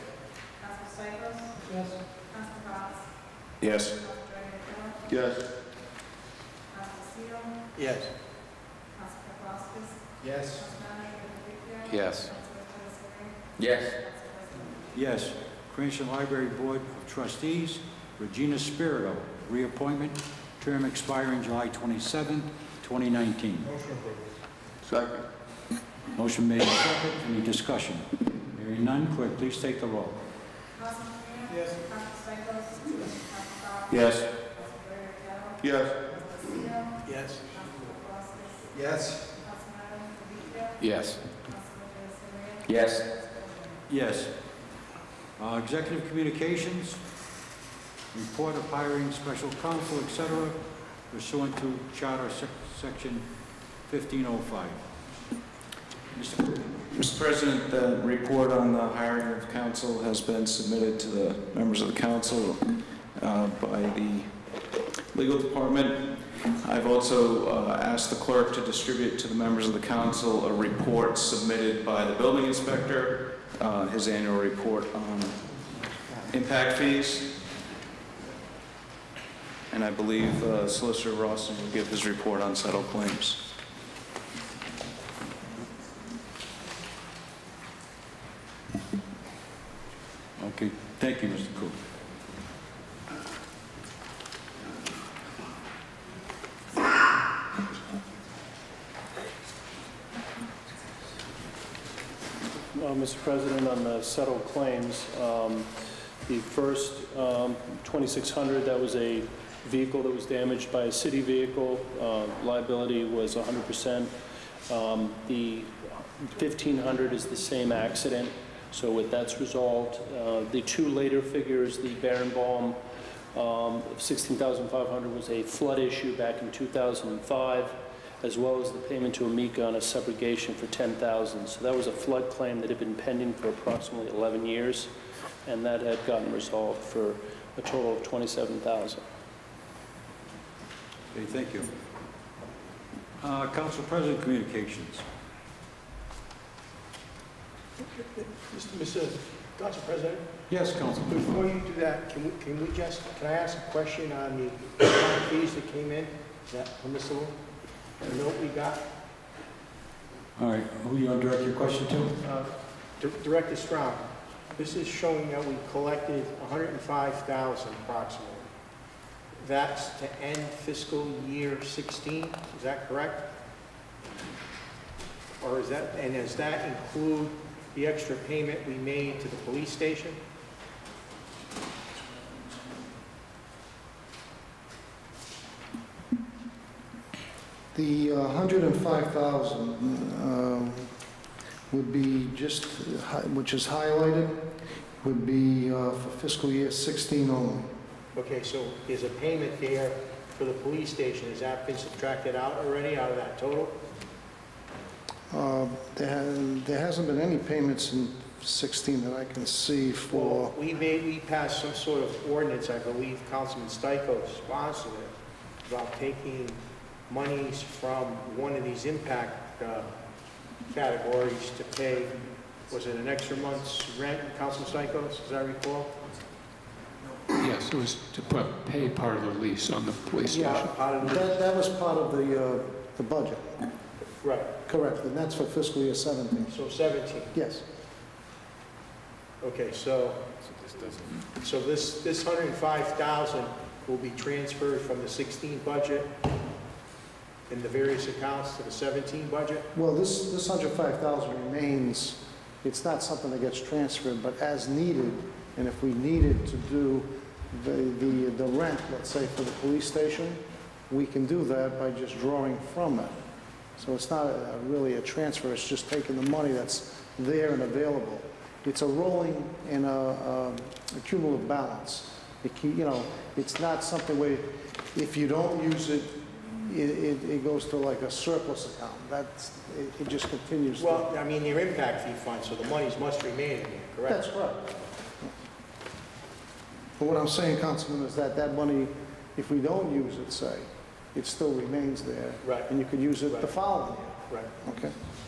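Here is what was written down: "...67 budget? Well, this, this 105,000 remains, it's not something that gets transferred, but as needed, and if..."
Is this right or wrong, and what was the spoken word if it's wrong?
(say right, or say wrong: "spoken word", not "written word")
wrong: "17", not "67".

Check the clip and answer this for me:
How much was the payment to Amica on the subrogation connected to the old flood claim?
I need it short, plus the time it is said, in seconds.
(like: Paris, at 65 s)
10000, at 130 s.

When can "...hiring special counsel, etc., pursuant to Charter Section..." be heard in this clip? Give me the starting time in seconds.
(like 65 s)
48 s.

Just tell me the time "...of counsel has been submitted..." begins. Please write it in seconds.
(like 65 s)
59 s.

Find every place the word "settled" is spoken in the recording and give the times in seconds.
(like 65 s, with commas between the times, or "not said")
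82 s, 104 s.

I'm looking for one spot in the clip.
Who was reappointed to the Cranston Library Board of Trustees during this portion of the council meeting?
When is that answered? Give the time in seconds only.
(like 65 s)
18 s.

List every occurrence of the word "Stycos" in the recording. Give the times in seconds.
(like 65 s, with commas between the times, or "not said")
0 s, 213 s, 224 s.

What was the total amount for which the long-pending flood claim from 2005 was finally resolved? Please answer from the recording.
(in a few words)
27000.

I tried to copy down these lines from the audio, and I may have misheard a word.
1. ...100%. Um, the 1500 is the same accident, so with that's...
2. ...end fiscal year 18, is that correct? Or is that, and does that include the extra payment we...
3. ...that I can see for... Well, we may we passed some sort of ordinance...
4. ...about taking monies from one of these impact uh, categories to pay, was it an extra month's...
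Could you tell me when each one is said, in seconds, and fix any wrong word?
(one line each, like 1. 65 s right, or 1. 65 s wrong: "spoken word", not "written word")
1. 113 s right
2. 170 s wrong: "16", not "18"
3. 209 s right
4. 215 s right.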